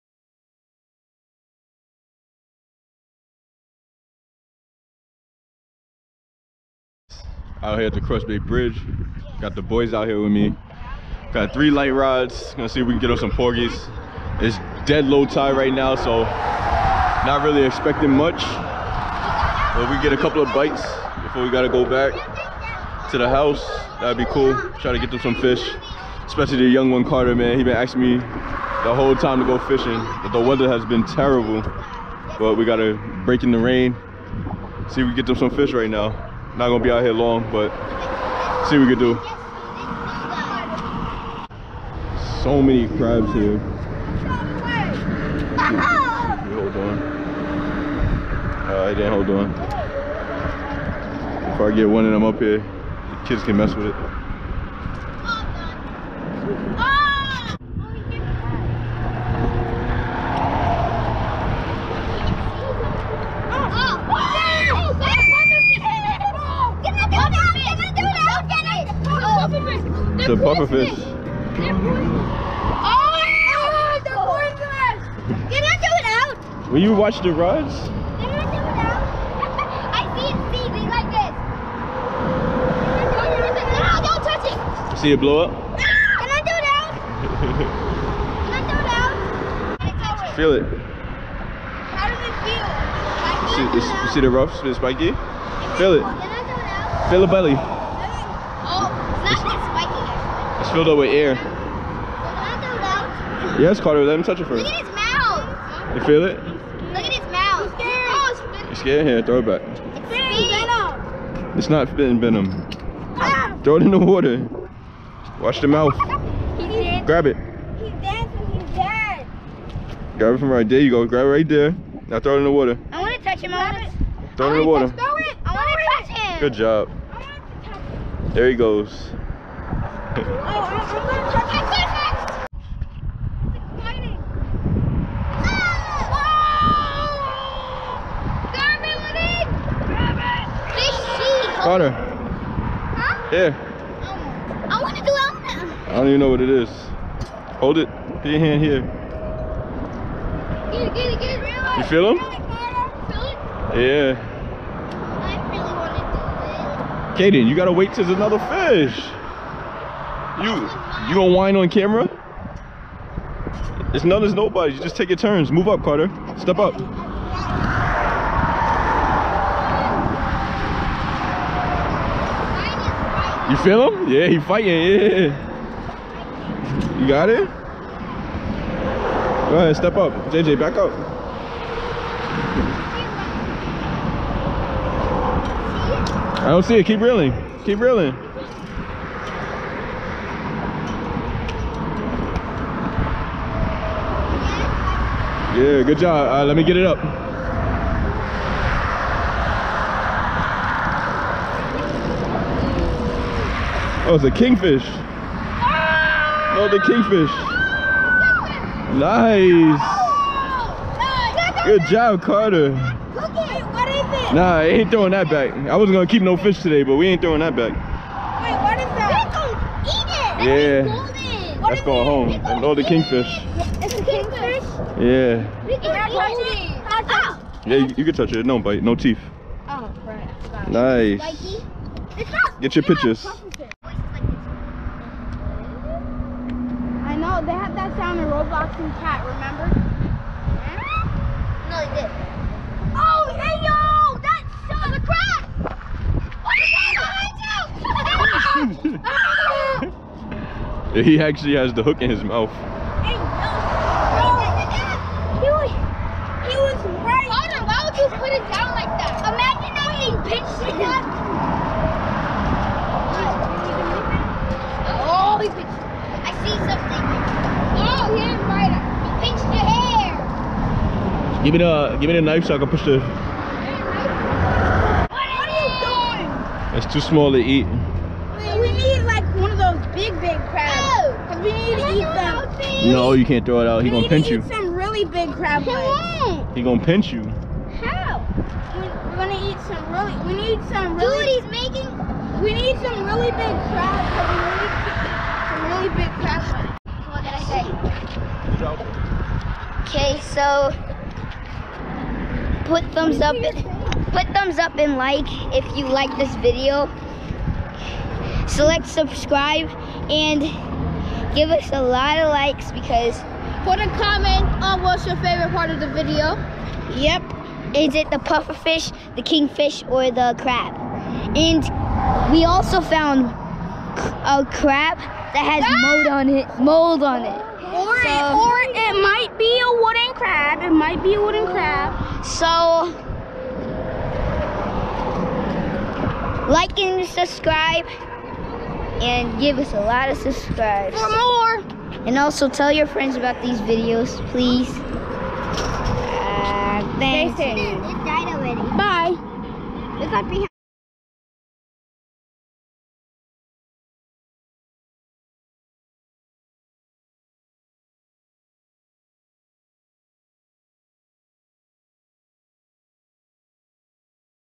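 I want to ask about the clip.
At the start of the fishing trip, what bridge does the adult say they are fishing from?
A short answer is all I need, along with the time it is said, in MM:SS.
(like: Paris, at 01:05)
Cross Bay Bridge, at 00:08.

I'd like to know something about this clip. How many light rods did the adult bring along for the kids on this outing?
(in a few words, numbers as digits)
3.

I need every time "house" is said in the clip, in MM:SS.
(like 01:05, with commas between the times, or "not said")
00:23.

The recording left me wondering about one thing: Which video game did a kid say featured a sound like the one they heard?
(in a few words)
Roblox.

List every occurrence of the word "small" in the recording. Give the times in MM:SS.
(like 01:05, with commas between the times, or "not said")
04:37.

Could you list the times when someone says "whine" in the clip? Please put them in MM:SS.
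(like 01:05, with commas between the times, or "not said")
02:41.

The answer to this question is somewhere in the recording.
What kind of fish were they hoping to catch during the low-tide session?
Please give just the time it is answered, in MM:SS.
00:13.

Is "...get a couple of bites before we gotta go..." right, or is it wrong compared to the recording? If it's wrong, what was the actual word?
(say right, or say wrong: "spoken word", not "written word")
right.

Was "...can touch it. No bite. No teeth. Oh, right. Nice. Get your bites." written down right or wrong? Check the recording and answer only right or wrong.
wrong.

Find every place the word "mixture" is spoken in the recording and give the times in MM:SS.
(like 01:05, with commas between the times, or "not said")
not said.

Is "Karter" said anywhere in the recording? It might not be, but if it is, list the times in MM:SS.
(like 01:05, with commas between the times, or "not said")
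00:27, 02:45, 03:32.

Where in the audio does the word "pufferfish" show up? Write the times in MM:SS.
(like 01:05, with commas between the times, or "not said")
01:10, 05:18.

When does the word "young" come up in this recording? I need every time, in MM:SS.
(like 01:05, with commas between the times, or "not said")
00:26.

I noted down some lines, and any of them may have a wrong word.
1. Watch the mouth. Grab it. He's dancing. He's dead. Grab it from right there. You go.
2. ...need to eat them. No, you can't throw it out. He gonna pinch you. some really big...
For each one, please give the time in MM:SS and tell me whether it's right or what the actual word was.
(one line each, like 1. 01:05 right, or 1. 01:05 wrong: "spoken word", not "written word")
1. 01:55 right
2. 04:41 right.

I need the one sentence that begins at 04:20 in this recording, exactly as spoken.
pitched it Oh, he pitched I see something.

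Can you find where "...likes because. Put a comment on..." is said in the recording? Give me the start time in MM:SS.
05:12.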